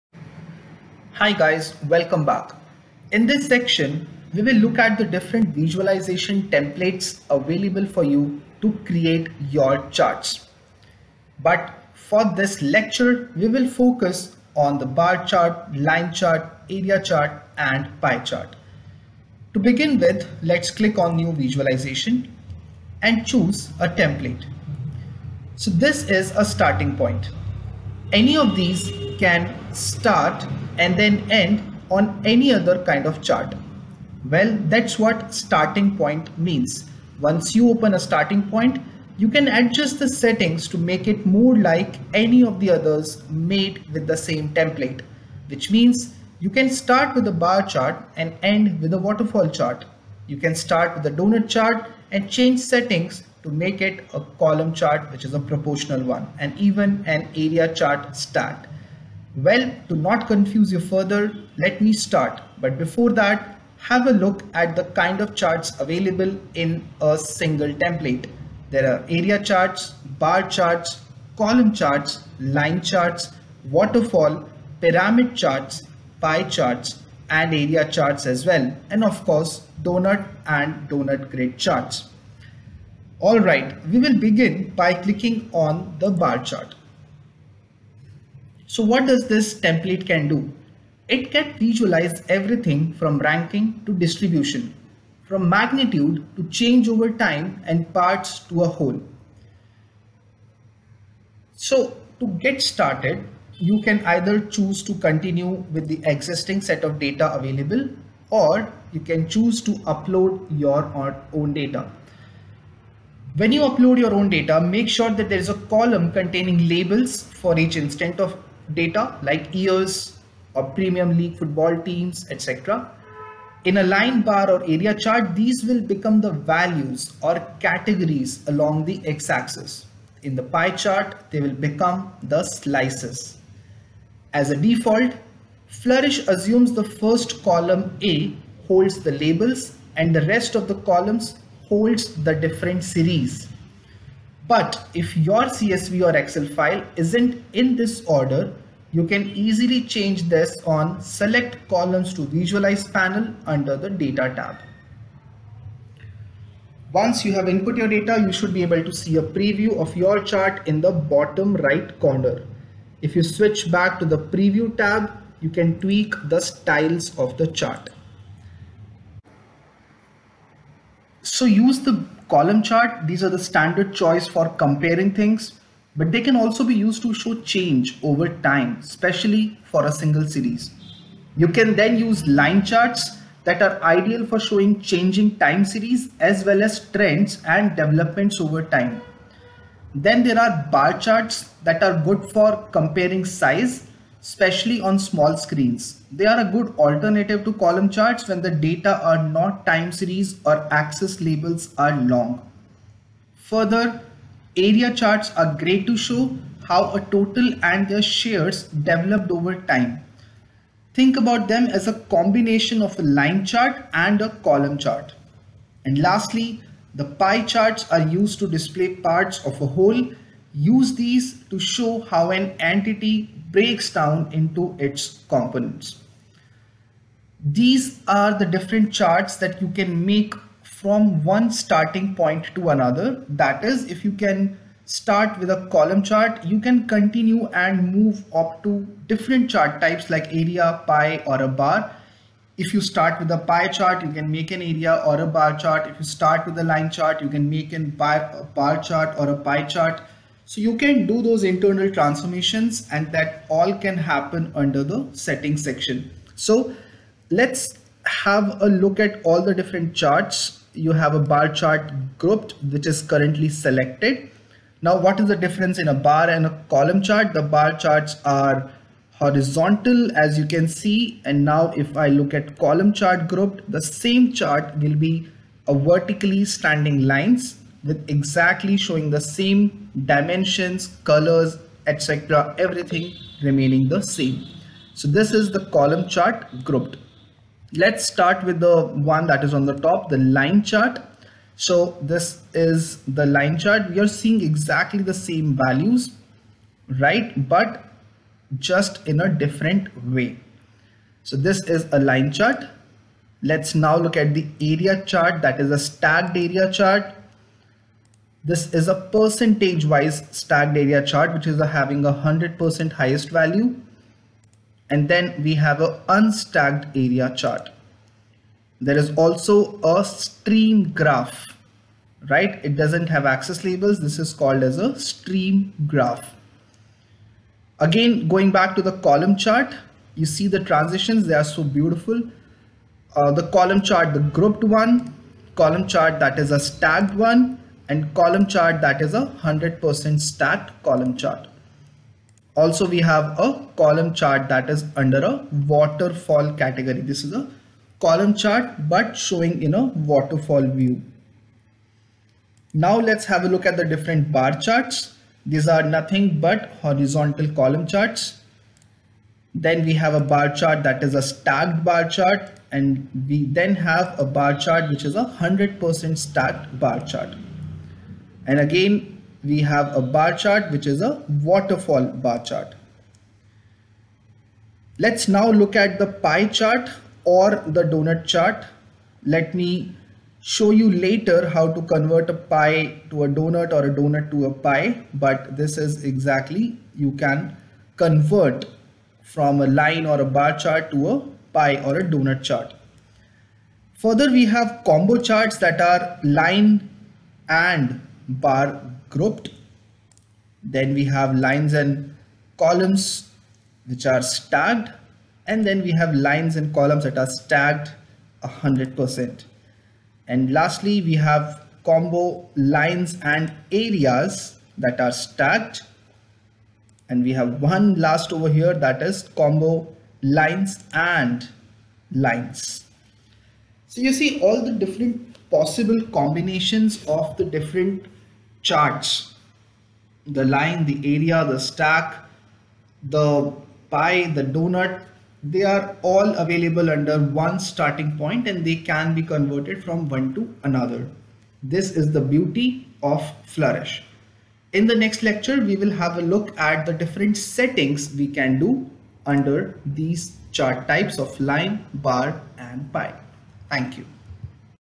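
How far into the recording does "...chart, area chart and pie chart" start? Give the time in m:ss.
0:16.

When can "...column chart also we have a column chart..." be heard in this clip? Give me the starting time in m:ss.
5:40.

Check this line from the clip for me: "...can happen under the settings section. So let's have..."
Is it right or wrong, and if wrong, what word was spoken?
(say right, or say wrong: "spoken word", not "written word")
right.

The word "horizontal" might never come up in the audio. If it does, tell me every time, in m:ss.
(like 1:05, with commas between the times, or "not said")
4:29, 5:56.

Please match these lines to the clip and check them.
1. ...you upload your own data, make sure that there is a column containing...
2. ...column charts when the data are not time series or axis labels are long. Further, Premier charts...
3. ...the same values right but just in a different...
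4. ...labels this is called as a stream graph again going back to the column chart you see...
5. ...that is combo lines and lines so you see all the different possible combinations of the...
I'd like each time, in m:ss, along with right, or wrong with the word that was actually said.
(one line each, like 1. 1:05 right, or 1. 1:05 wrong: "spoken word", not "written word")
1. 1:53 right
2. 3:17 wrong: "Area", not "Premier"
3. 4:55 right
4. 5:23 right
5. 6:58 right.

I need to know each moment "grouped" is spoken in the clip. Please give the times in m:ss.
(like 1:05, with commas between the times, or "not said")
4:22, 4:33, 4:46, 5:34, 6:39.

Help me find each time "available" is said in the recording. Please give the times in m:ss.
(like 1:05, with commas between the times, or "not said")
0:07, 1:05, 1:47, 7:16.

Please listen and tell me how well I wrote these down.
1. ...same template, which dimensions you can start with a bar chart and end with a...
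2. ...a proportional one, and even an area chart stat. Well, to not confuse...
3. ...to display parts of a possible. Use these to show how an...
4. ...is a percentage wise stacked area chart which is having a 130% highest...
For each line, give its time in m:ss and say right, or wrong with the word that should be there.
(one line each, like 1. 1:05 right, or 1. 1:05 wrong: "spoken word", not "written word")
1. 0:44 wrong: "means", not "dimensions"
2. 0:55 right
3. 3:38 wrong: "whole", not "possible"
4. 5:08 wrong: "100", not "130".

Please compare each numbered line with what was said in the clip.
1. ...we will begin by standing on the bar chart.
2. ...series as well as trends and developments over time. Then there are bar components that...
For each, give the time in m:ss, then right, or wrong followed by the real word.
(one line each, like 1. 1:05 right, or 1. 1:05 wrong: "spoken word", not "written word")
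1. 1:23 wrong: "clicking", not "standing"
2. 3:05 wrong: "charts", not "components".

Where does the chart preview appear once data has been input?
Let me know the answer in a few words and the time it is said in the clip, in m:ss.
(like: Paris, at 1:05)
bottom right, at 2:40.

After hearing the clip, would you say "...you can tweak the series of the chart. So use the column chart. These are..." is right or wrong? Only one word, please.
wrong.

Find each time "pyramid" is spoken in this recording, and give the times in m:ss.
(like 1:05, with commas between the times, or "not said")
1:14.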